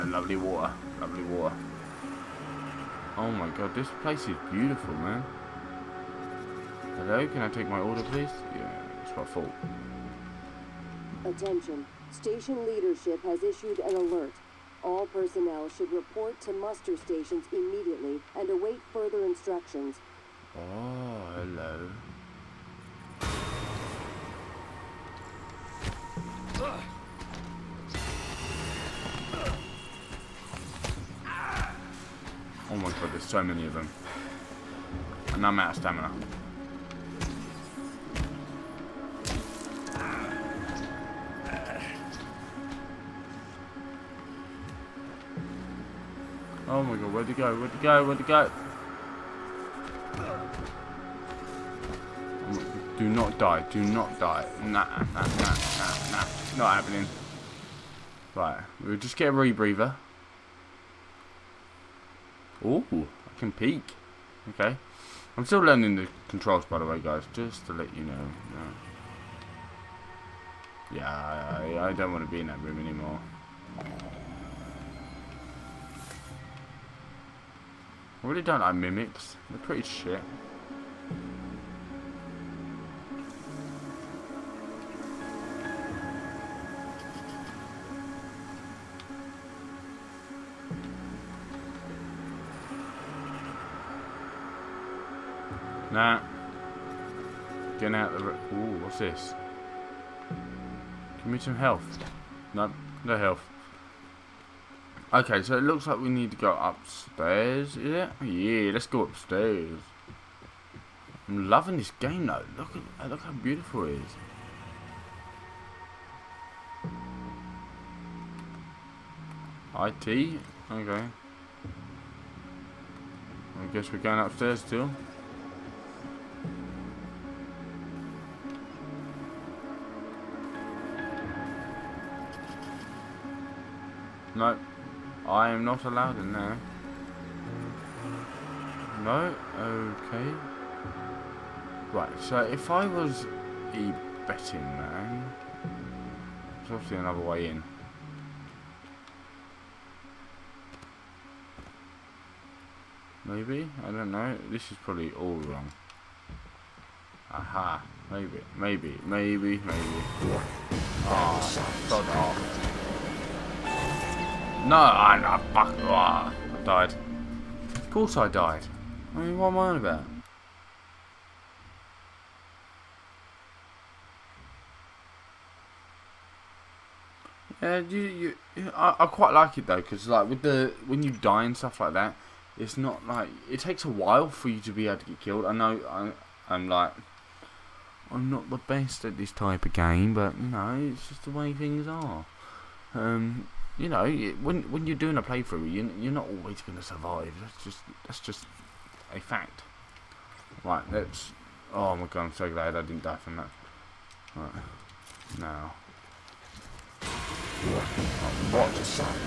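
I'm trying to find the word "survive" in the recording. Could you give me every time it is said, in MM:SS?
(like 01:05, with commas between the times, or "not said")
03:16.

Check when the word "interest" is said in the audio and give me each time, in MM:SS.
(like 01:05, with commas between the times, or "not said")
not said.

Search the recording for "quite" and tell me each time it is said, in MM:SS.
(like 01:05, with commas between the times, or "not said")
02:59.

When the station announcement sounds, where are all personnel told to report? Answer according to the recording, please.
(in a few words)
Muster stations.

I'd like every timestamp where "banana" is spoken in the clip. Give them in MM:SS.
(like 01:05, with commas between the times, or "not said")
not said.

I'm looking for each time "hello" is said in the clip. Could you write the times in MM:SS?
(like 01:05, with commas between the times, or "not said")
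00:06, 00:21.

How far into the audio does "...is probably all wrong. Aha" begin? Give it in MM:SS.
02:34.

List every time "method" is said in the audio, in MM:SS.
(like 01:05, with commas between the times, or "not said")
not said.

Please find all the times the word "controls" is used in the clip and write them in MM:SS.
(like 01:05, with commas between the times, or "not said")
01:06.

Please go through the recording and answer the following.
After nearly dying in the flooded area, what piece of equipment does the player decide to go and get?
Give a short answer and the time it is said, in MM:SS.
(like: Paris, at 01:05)
A rebreather, at 00:59.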